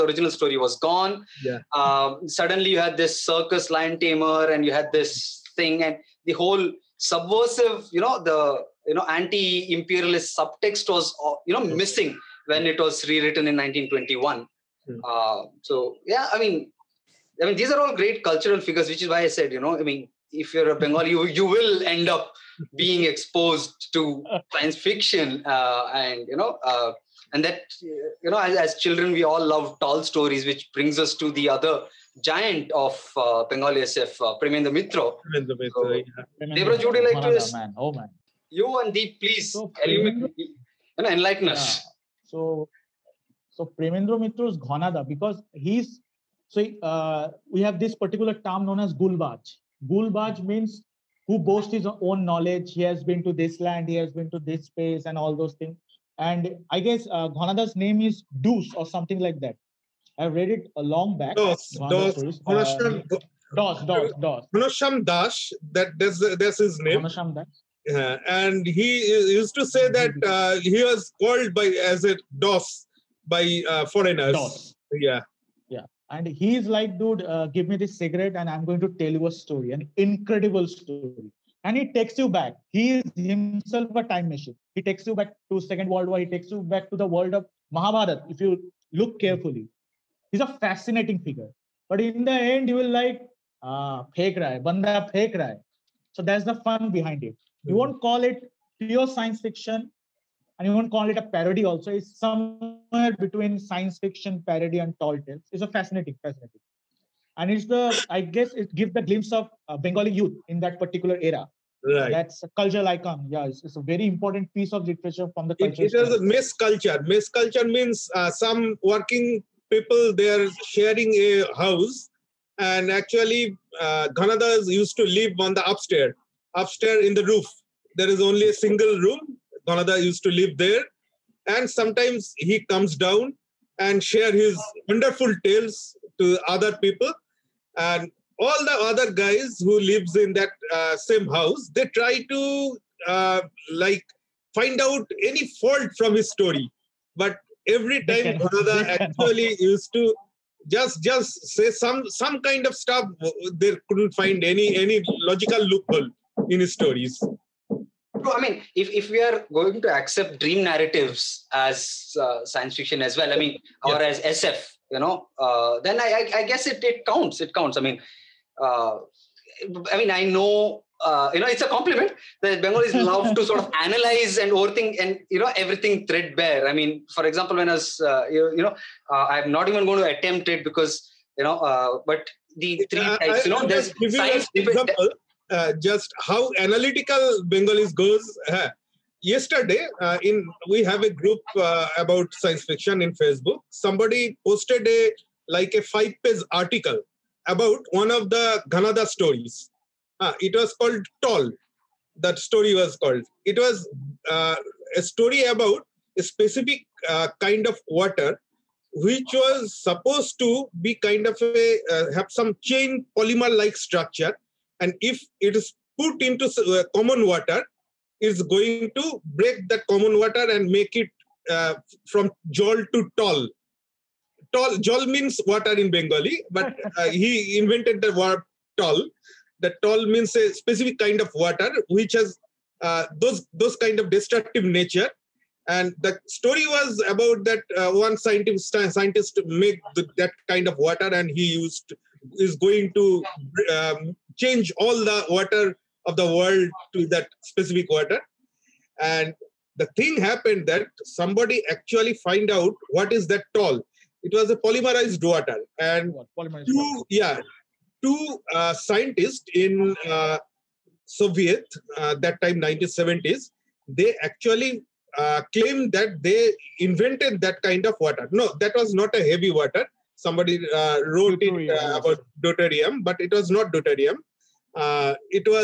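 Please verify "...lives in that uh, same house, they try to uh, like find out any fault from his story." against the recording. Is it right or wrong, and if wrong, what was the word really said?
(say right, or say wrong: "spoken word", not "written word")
right.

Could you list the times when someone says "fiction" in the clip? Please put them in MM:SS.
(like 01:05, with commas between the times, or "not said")
00:24, 01:39, 01:43, 02:42, 03:12.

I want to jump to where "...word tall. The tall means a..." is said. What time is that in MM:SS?
03:48.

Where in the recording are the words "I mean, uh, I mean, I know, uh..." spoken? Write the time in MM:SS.
02:47.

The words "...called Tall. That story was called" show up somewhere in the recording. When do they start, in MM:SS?
03:20.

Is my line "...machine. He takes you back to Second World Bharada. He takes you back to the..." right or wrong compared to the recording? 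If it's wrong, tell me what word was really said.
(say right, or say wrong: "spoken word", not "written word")
wrong: "War", not "Bharada".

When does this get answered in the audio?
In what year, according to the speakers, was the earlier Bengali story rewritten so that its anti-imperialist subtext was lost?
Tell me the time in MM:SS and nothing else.
00:13.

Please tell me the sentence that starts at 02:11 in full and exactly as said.
And sometimes he comes down and share his wonderful tales to other people.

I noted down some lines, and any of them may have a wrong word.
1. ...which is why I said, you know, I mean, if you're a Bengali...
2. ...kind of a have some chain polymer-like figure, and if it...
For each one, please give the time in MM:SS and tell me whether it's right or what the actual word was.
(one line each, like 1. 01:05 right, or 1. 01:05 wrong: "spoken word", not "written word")
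1. 00:18 right
2. 03:30 wrong: "structure", not "figure".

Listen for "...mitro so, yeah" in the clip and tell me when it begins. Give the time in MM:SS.
00:35.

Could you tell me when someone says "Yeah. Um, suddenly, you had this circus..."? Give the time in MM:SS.
00:01.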